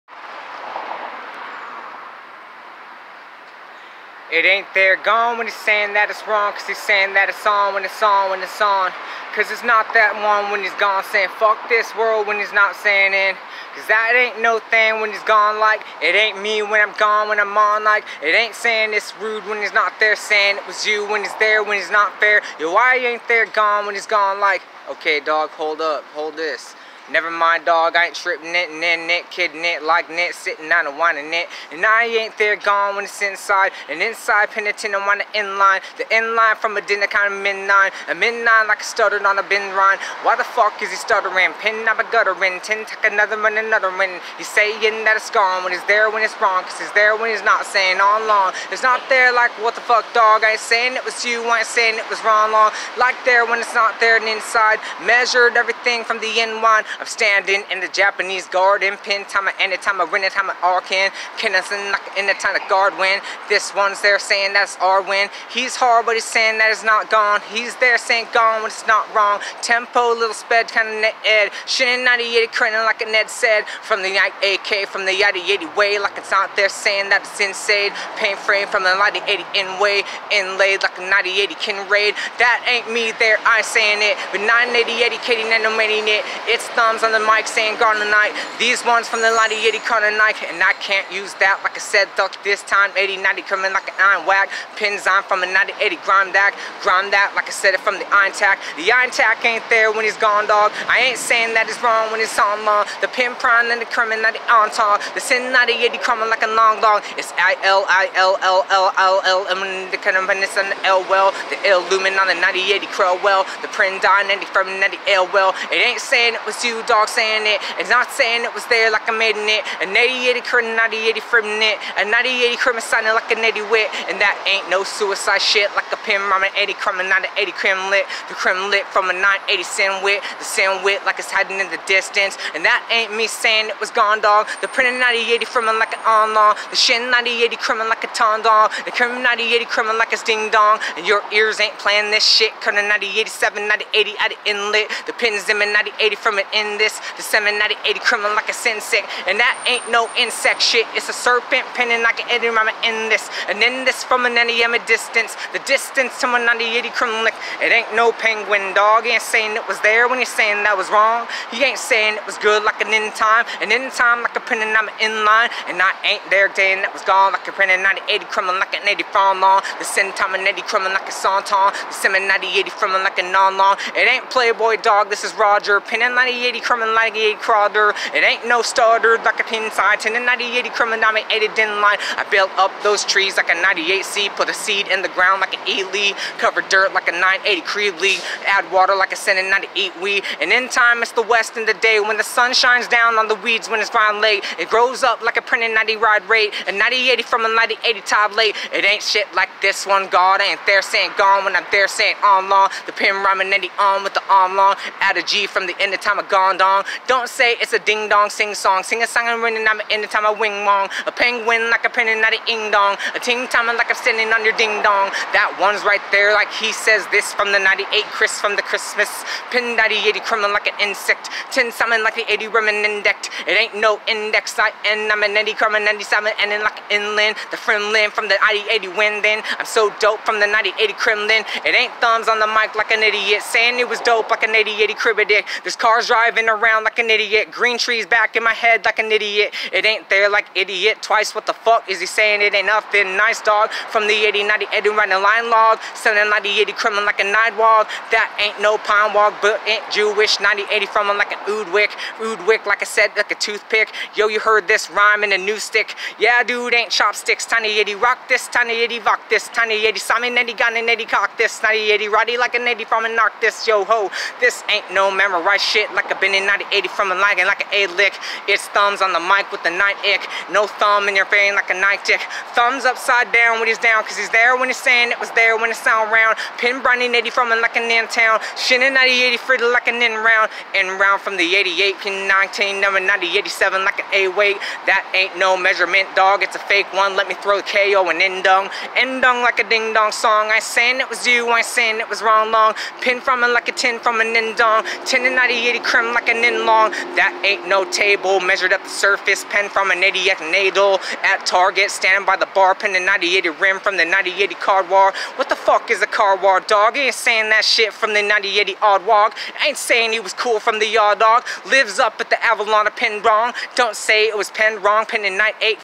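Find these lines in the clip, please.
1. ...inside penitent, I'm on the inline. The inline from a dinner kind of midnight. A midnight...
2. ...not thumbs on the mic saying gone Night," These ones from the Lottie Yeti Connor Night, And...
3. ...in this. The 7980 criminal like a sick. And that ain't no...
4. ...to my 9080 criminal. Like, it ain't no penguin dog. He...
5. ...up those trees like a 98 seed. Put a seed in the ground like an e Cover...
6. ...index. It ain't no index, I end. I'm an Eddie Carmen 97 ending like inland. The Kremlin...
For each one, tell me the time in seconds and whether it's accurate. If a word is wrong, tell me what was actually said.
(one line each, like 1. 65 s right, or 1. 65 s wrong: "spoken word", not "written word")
1. 34 s right
2. 86 s right
3. 146 s right
4. 156 s right
5. 182 s right
6. 222 s right.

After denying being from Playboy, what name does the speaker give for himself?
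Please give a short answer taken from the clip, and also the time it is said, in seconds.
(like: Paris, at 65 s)
Roger, at 175 s.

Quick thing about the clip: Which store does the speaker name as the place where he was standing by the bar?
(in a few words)
Target.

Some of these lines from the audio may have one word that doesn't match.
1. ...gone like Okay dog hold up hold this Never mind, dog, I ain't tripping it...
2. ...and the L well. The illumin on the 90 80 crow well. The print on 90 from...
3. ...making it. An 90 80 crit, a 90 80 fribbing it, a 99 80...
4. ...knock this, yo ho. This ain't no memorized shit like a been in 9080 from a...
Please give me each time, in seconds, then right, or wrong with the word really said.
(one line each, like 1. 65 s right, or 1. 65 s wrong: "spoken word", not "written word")
1. 24 s right
2. 110 s right
3. 119 s wrong: "90", not "99"
4. 263 s right.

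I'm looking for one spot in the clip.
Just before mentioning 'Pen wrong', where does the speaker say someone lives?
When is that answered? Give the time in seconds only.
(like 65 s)
312 s.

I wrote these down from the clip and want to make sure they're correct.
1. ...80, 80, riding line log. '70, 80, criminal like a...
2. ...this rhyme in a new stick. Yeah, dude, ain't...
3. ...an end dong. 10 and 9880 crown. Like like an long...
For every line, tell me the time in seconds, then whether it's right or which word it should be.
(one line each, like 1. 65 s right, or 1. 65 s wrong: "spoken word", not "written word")
1. 244 s wrong: "90", not "80"
2. 254 s right
3. 294 s wrong: "9080", not "9880".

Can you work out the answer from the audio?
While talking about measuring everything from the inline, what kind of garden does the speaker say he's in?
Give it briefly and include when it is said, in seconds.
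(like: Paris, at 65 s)
Japanese garden, at 57 s.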